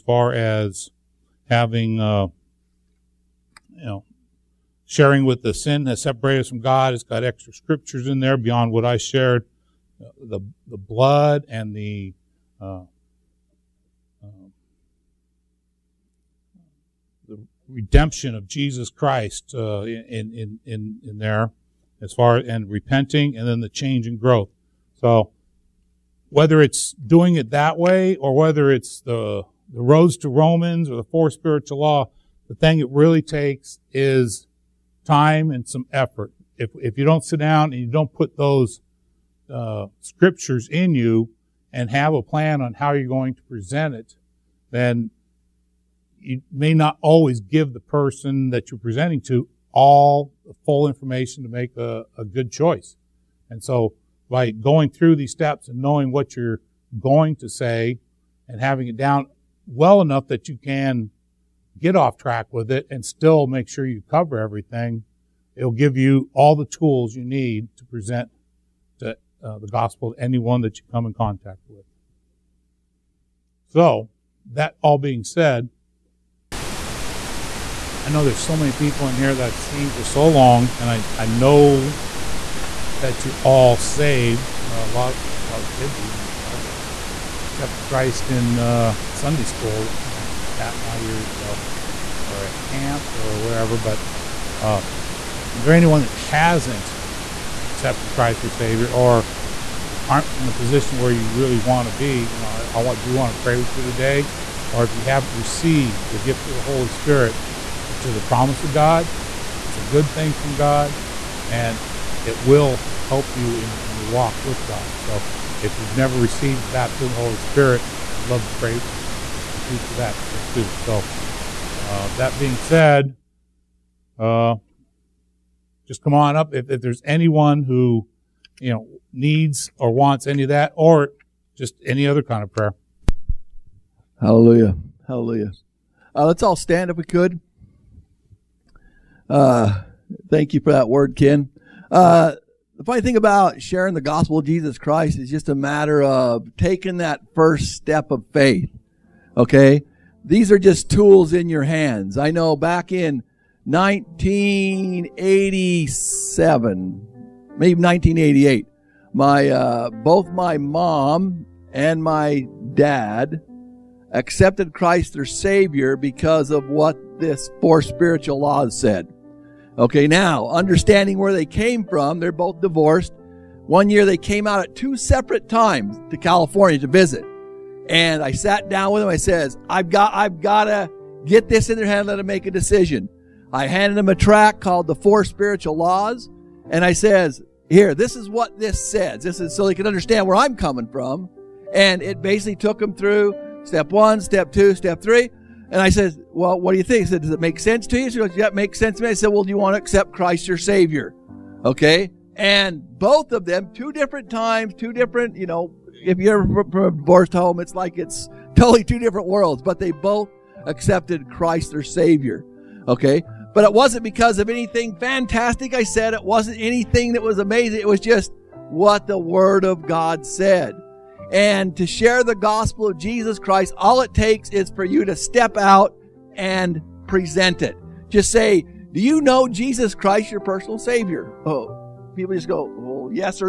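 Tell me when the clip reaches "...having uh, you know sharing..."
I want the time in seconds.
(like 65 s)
1 s.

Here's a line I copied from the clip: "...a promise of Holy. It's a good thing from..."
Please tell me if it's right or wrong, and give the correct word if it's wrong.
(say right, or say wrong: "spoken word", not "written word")
wrong: "God", not "Holy".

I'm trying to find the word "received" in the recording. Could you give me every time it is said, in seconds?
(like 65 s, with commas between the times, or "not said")
105 s, 116 s.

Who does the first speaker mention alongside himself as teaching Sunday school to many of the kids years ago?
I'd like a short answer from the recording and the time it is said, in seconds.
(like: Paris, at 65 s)
Pat, at 90 s.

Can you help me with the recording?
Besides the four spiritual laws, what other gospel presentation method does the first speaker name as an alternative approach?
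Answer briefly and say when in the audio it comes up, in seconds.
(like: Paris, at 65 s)
Roads to Romans, at 29 s.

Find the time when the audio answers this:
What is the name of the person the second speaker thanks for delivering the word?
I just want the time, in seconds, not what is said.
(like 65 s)
141 s.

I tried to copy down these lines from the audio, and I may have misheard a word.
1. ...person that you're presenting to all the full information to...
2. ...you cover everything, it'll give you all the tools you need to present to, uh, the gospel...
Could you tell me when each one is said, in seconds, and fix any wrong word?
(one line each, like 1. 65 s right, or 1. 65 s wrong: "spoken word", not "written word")
1. 47 s right
2. 63 s right.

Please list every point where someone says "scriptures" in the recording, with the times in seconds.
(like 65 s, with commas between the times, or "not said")
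7 s, 40 s.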